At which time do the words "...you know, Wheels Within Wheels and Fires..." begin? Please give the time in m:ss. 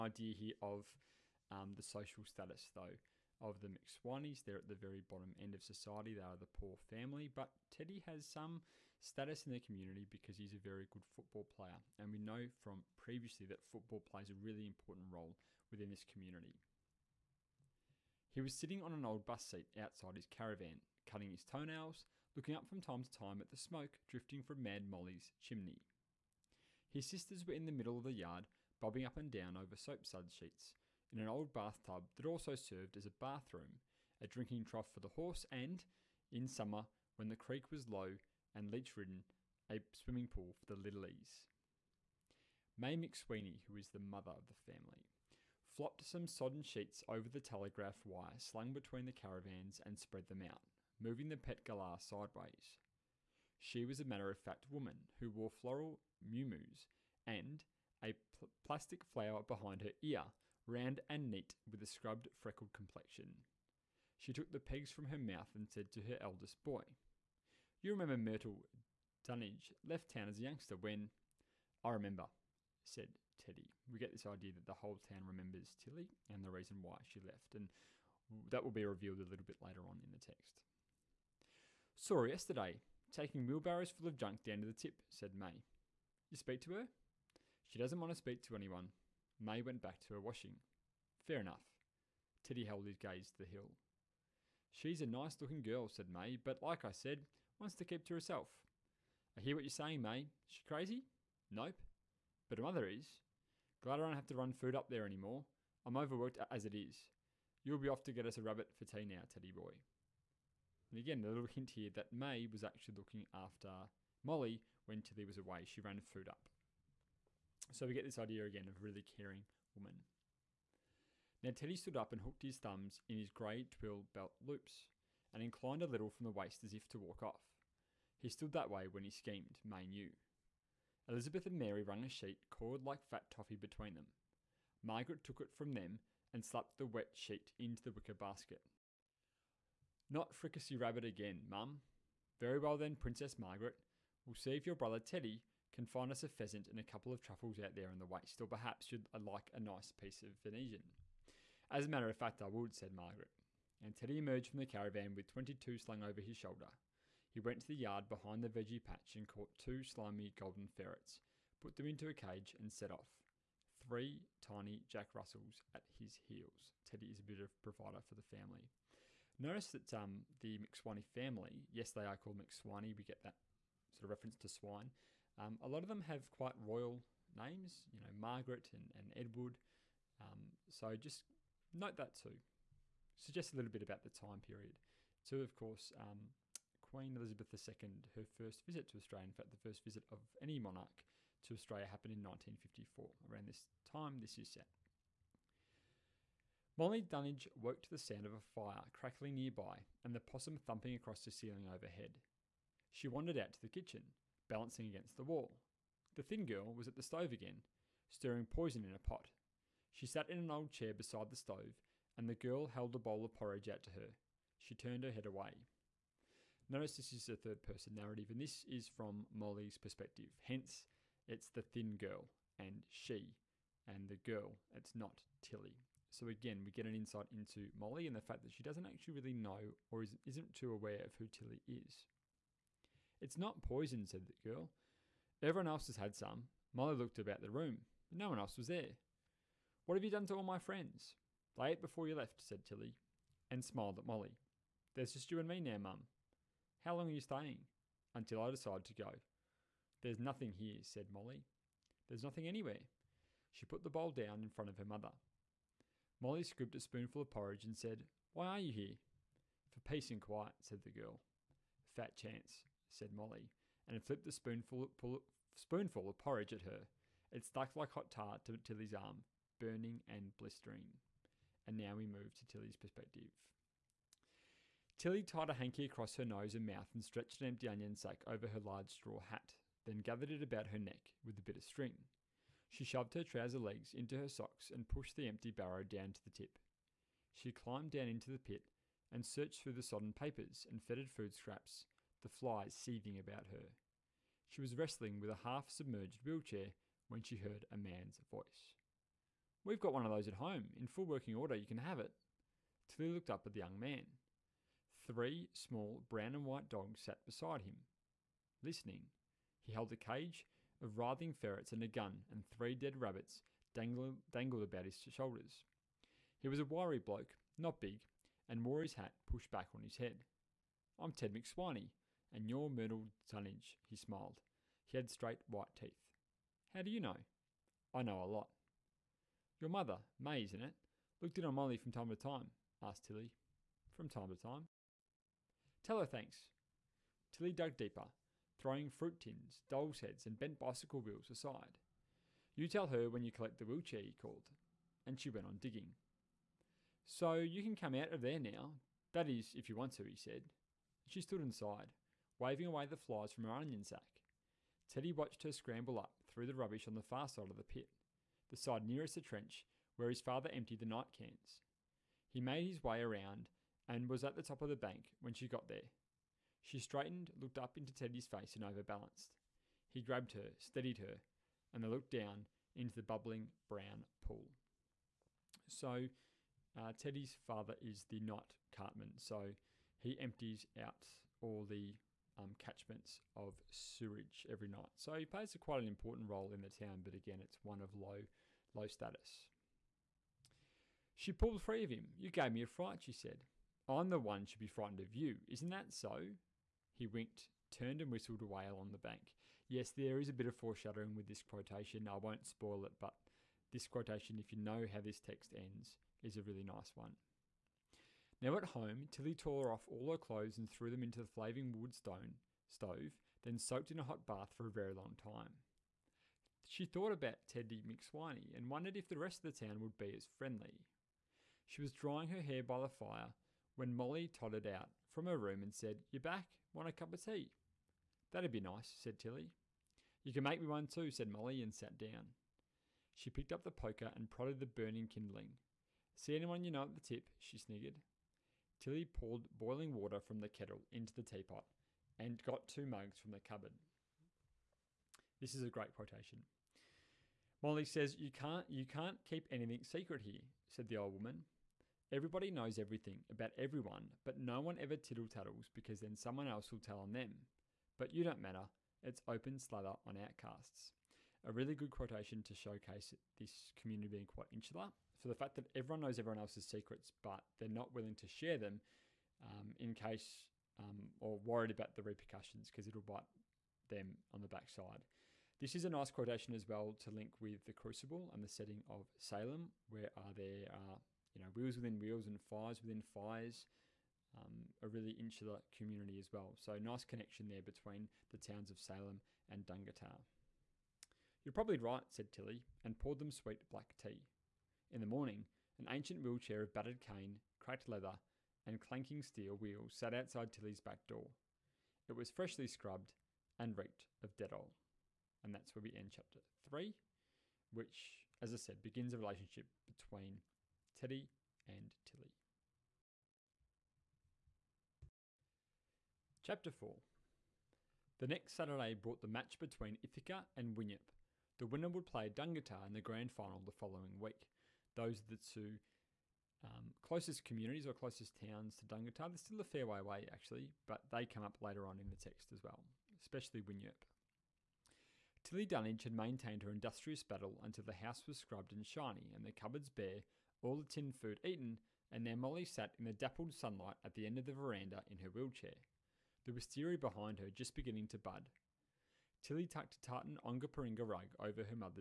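8:01.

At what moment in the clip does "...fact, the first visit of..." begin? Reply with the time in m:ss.
3:09.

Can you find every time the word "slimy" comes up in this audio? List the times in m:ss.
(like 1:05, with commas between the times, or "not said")
2:39.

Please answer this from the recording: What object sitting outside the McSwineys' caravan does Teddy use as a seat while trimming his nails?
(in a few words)
An old bus seat.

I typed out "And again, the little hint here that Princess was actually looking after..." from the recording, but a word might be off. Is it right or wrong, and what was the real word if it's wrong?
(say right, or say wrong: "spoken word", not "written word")
wrong: "Mae", not "Princess".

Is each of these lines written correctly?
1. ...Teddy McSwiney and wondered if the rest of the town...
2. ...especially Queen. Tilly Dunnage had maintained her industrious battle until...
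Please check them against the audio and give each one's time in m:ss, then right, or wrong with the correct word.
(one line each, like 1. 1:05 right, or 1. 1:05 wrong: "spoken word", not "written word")
1. 6:57 right
2. 8:53 wrong: "Winyerp", not "Queen".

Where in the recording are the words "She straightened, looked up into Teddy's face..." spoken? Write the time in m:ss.
6:06.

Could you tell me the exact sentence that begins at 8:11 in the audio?
You're probably right, said Tilly, and poured them sweet black tea.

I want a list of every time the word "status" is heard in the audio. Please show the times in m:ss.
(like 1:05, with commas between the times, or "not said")
0:02, 0:08, 6:28.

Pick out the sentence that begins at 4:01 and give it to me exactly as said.
They ate before you left, said Tilly, and smiled at Molly.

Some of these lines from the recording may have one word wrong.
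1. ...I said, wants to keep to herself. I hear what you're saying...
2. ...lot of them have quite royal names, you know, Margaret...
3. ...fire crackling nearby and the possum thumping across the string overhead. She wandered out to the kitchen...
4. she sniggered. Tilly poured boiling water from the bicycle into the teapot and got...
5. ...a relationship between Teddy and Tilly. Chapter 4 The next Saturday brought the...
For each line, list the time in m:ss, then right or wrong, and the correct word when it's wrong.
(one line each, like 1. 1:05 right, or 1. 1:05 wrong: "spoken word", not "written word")
1. 1:36 right
2. 2:55 right
3. 3:18 wrong: "ceiling", not "string"
4. 7:17 wrong: "kettle", not "bicycle"
5. 8:29 right.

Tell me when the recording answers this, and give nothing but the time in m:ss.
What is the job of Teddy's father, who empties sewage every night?
6:18.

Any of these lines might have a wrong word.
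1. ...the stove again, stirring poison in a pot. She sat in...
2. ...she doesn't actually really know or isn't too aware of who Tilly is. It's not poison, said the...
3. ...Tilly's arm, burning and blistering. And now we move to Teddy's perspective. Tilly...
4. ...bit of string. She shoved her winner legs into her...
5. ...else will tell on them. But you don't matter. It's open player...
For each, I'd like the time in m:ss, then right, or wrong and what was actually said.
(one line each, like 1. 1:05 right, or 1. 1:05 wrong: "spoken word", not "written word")
1. 3:26 right
2. 3:48 right
3. 4:28 wrong: "Tilly", not "Teddy"
4. 4:41 wrong: "trouser", not "winner"
5. 7:36 wrong: "slather", not "player".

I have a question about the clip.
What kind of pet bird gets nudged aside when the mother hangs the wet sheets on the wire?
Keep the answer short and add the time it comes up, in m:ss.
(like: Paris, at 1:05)
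Galah, at 0:51.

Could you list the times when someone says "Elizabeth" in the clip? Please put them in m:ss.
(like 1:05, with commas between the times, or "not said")
2:11, 3:07.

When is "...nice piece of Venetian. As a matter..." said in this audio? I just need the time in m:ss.
2:29.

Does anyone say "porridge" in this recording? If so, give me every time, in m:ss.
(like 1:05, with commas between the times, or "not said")
3:33, 4:17, 4:26.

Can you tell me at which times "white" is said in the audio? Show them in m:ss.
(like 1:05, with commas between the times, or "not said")
5:06, 5:25.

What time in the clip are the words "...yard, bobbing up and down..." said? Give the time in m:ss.
0:28.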